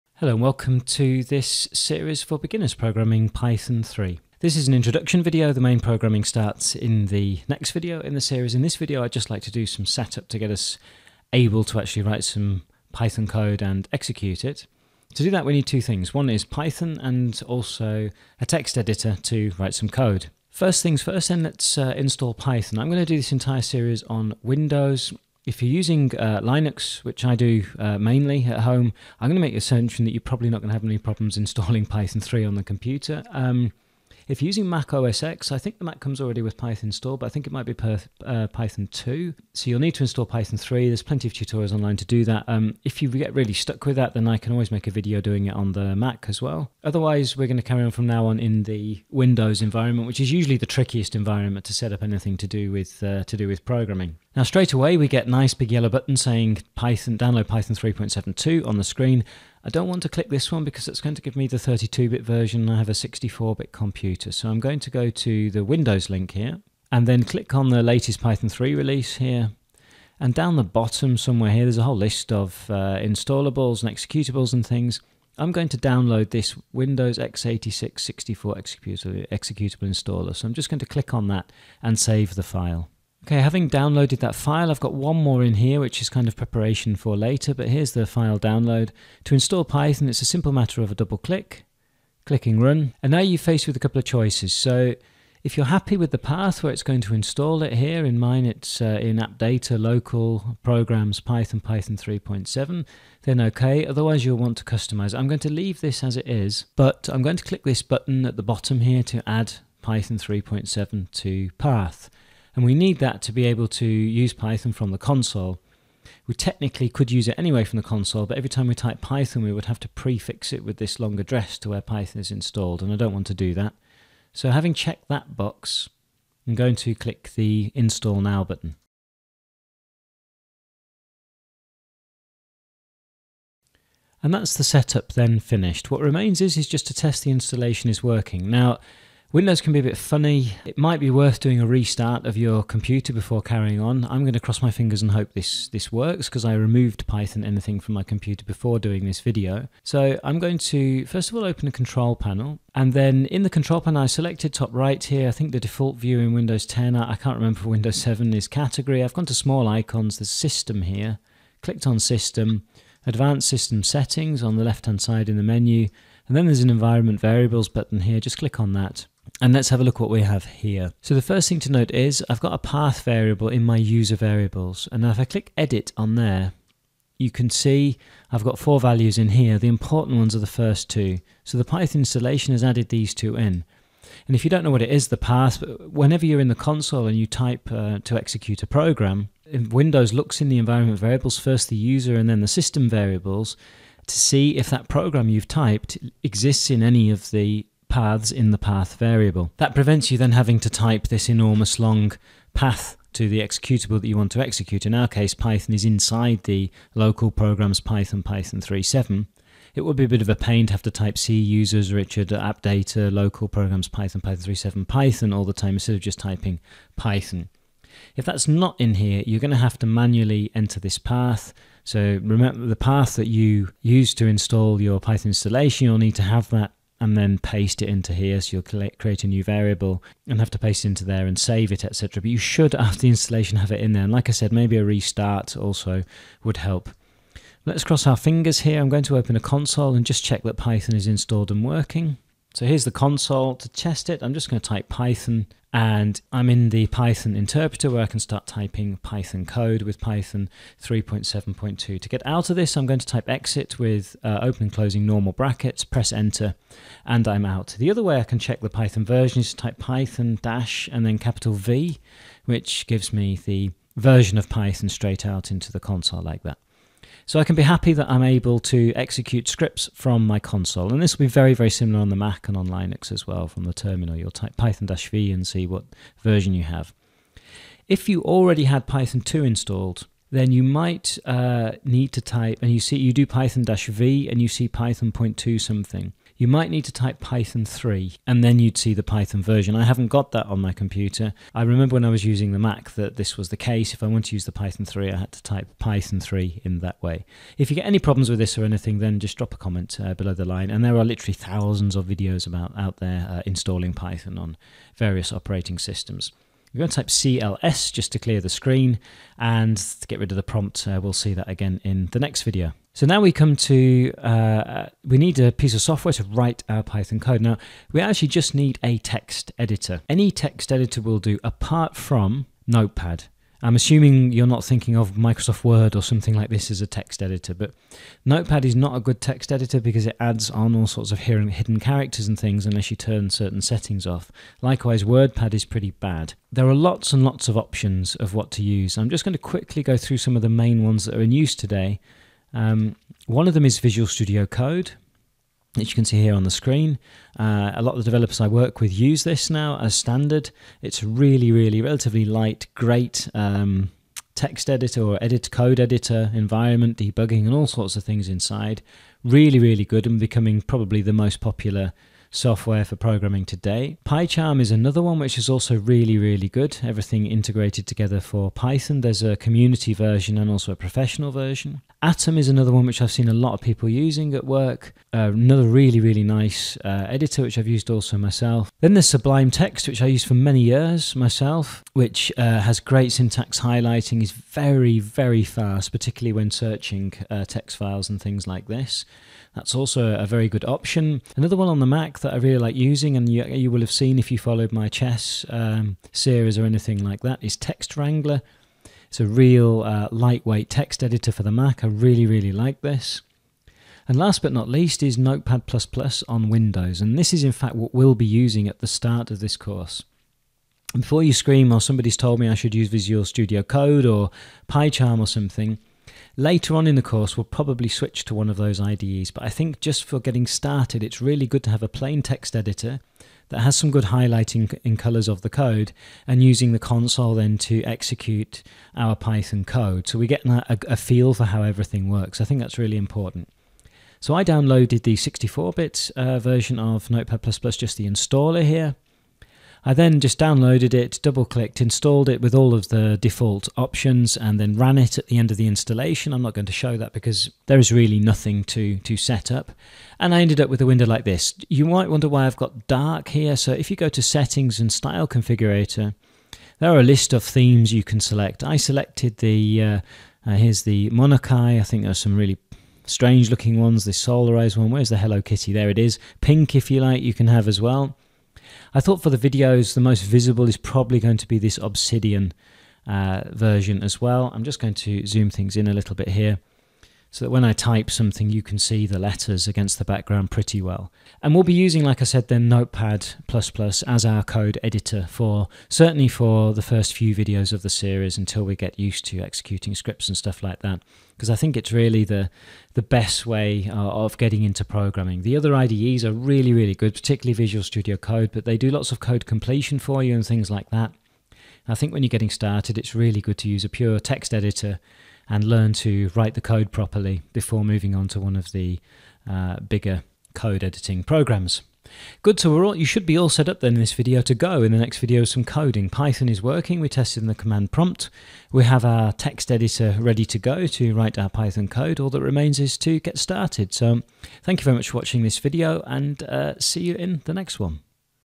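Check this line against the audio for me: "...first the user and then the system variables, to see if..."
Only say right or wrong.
right.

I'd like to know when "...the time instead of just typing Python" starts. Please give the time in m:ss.
3:35.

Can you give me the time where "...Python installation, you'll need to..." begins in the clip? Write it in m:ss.
3:45.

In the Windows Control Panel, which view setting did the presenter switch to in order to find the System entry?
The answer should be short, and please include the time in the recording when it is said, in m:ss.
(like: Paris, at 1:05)
Small icons, at 2:39.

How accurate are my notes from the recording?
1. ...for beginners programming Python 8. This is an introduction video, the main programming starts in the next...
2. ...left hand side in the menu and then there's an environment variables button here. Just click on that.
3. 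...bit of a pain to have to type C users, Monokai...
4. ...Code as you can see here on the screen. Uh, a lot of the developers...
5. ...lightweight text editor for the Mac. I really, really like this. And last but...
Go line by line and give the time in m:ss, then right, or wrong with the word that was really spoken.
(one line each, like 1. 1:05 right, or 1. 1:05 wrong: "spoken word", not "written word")
1. 0:02 wrong: "3", not "8"
2. 2:44 right
3. 3:30 wrong: "Richard", not "Monokai"
4. 5:44 right
5. 6:40 right.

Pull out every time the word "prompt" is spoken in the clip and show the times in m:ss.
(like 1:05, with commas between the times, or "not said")
5:10, 8:37.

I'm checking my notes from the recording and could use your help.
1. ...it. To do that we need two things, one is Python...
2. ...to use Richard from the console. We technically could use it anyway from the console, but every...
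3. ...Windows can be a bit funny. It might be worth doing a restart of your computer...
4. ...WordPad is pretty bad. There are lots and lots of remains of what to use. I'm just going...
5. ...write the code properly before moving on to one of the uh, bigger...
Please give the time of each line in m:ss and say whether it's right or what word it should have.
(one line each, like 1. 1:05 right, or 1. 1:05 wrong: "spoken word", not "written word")
1. 0:14 right
2. 1:53 wrong: "Python", not "Richard"
3. 2:19 right
4. 5:35 wrong: "options", not "remains"
5. 8:26 right.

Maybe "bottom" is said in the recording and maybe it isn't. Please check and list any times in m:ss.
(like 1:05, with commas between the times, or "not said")
1:10, 1:48.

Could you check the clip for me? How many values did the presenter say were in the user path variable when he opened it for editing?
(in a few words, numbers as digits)
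4.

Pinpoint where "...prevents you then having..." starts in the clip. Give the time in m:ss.
3:19.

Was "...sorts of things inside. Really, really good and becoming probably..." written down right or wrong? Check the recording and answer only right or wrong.
right.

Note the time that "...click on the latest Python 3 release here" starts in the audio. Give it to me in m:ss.
1:07.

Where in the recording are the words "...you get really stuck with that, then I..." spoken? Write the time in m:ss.
0:43.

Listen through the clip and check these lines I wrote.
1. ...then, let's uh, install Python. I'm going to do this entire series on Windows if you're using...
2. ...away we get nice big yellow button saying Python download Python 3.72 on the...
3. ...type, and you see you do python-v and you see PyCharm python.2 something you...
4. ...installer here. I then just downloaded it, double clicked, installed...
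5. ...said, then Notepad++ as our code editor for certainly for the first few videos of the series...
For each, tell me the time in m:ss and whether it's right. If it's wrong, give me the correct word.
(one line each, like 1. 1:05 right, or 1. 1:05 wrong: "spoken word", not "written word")
1. 0:21 right
2. 0:54 right
3. 4:42 wrong: "Python", not "PyCharm"
4. 7:18 right
5. 8:02 right.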